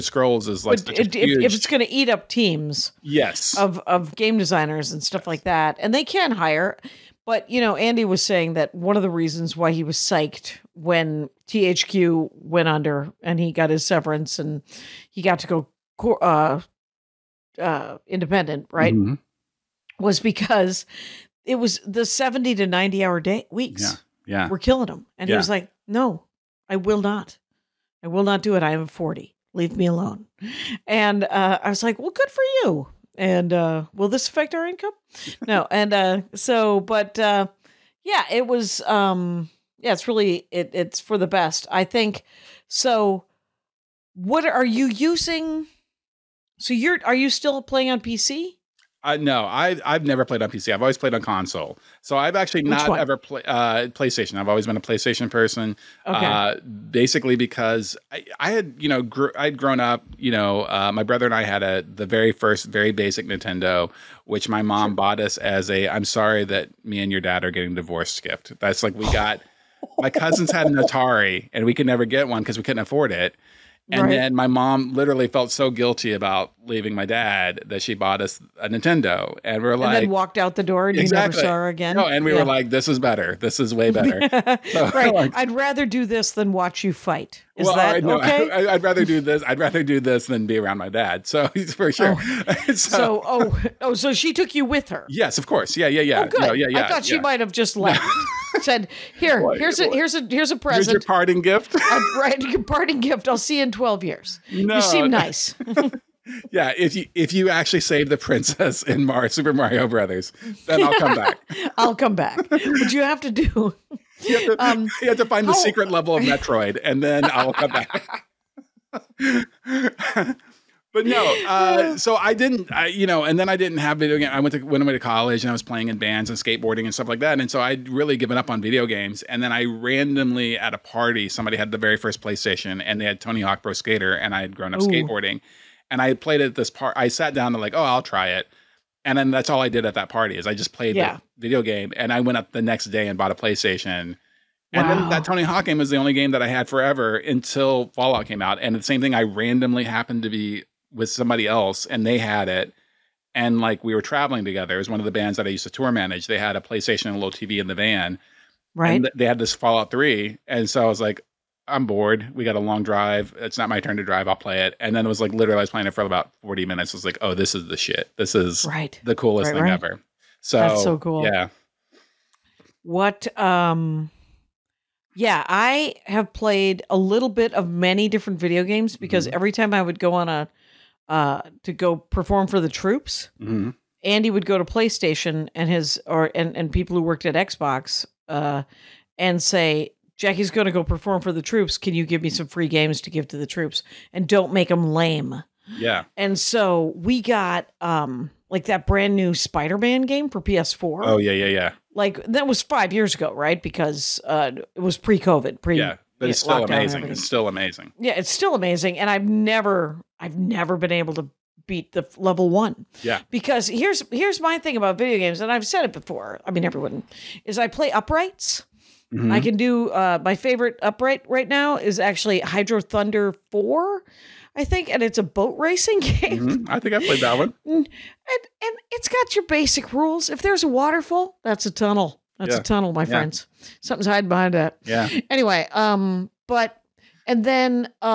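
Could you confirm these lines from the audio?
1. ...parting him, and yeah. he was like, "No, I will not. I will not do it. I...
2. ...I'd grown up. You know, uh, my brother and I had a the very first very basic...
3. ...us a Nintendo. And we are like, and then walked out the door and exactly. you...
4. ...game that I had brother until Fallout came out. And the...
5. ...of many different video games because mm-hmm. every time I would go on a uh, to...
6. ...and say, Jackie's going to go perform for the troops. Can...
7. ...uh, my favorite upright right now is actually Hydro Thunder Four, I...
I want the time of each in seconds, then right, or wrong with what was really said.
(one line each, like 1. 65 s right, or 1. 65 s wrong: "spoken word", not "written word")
1. 24 s wrong: "killing", not "parting"
2. 59 s right
3. 78 s right
4. 146 s wrong: "forever", not "brother"
5. 177 s right
6. 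189 s right
7. 219 s right.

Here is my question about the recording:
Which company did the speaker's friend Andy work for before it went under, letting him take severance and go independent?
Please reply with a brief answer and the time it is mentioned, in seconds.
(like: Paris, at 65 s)
THQ, at 11 s.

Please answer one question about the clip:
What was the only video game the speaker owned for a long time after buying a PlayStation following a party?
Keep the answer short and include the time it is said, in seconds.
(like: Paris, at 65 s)
Tony Hawk Pro Skater, at 133 s.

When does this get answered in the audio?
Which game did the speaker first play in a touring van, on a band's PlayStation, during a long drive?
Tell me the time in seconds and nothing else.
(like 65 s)
159 s.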